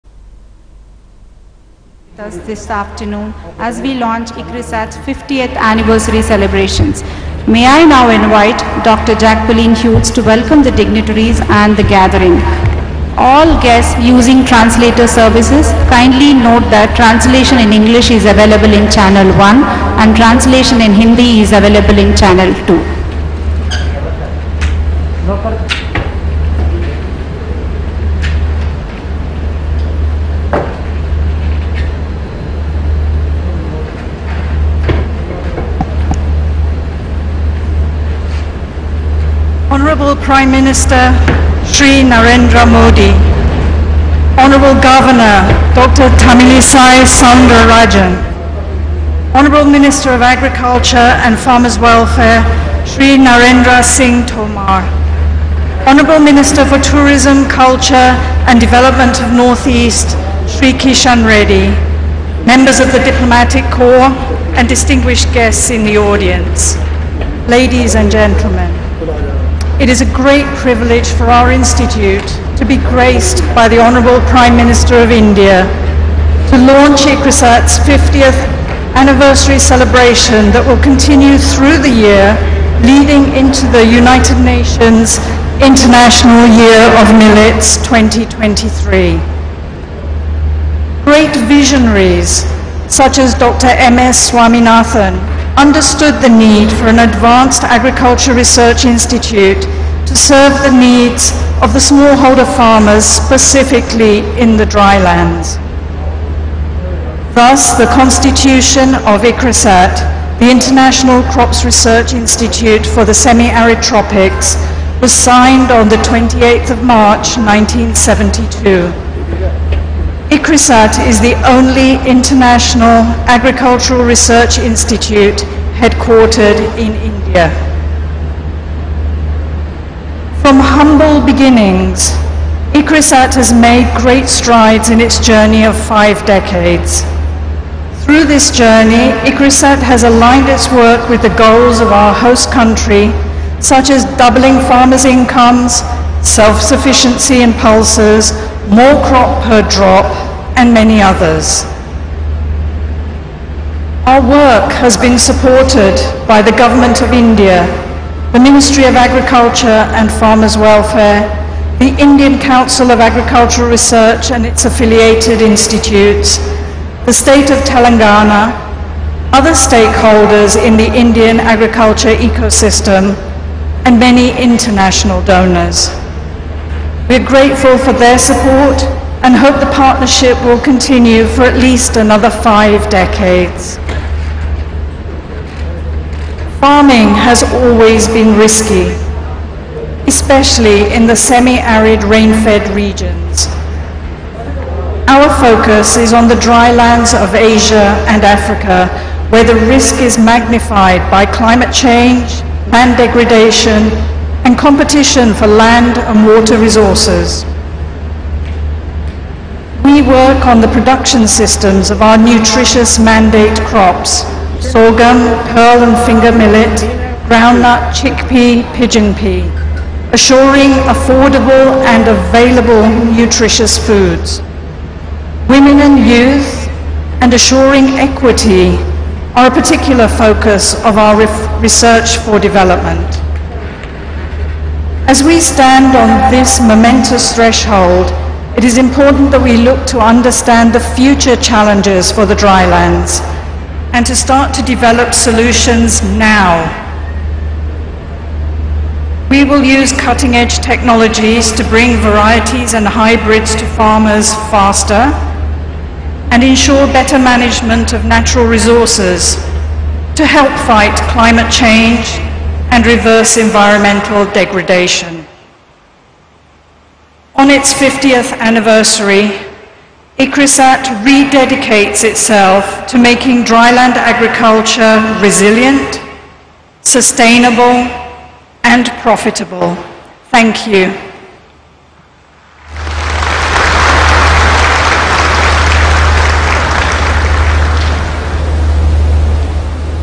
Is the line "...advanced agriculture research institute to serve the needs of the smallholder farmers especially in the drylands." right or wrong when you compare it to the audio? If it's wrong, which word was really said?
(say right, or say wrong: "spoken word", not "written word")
wrong: "specifically", not "especially".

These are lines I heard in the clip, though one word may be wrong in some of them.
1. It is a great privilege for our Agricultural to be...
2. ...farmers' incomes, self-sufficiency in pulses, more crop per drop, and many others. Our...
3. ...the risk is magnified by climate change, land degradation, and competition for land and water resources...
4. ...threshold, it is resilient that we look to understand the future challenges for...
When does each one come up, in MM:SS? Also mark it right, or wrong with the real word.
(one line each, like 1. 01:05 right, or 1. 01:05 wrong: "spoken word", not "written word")
1. 01:09 wrong: "Institute", not "Agricultural"
2. 02:24 right
3. 03:19 right
4. 03:57 wrong: "important", not "resilient".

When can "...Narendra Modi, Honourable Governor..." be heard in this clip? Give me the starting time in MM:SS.
00:42.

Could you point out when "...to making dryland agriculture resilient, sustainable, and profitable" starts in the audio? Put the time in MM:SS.
04:32.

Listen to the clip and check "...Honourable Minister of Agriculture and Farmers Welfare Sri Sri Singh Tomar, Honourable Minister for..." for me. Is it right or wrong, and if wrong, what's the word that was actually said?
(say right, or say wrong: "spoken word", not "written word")
wrong: "Narendra", not "Sri".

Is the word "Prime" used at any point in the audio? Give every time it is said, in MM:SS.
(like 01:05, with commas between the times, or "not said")
00:40, 01:14.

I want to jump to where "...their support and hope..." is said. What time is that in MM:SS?
02:57.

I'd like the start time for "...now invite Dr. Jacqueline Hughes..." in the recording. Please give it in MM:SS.
00:07.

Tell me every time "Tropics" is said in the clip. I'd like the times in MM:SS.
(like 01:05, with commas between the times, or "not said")
01:53.